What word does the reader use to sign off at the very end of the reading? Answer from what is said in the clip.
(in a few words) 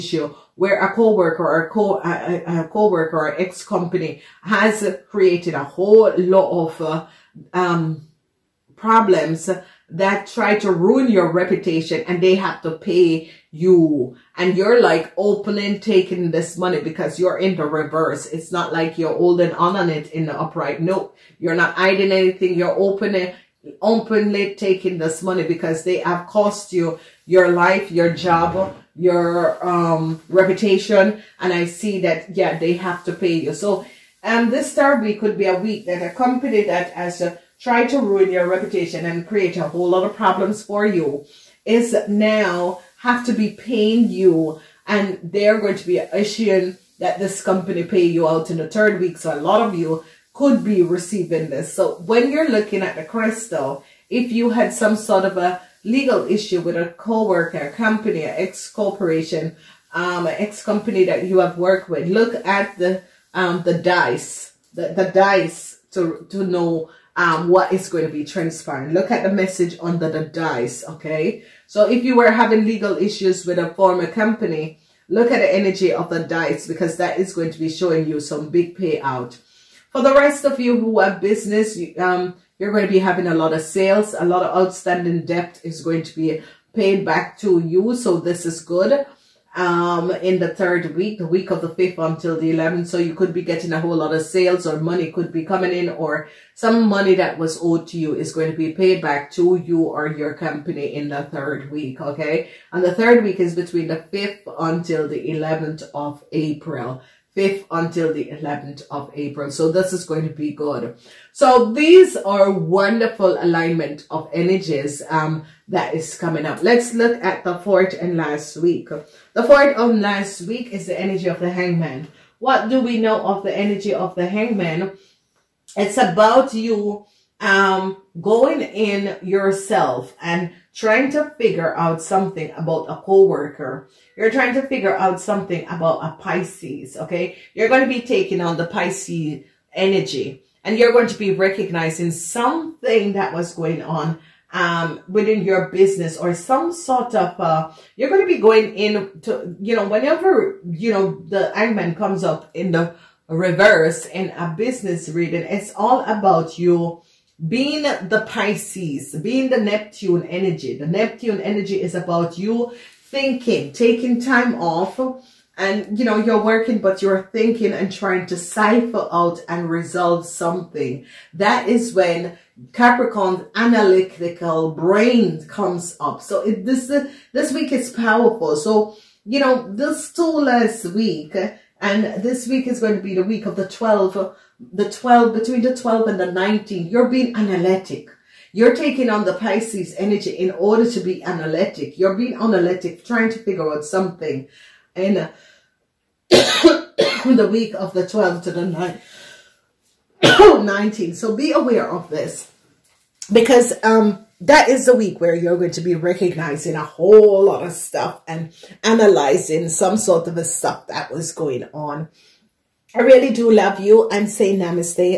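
namaste.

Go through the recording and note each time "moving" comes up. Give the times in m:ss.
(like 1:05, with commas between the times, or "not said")
not said.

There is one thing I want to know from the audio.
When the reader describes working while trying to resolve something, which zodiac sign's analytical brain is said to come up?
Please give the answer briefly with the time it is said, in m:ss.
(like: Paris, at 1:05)
Capricorn, at 2:52.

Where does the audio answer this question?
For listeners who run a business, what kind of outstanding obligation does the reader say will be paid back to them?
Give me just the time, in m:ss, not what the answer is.
1:25.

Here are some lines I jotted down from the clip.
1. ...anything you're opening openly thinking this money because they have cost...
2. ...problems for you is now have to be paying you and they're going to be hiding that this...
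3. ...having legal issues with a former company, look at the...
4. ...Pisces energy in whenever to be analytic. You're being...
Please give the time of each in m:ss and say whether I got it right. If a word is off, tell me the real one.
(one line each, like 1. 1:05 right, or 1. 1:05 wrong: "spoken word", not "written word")
1. 0:22 wrong: "taking", not "thinking"
2. 0:40 wrong: "issuing", not "hiding"
3. 1:12 right
4. 3:09 wrong: "order", not "whenever".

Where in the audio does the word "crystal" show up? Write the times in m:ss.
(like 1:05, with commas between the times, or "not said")
0:53.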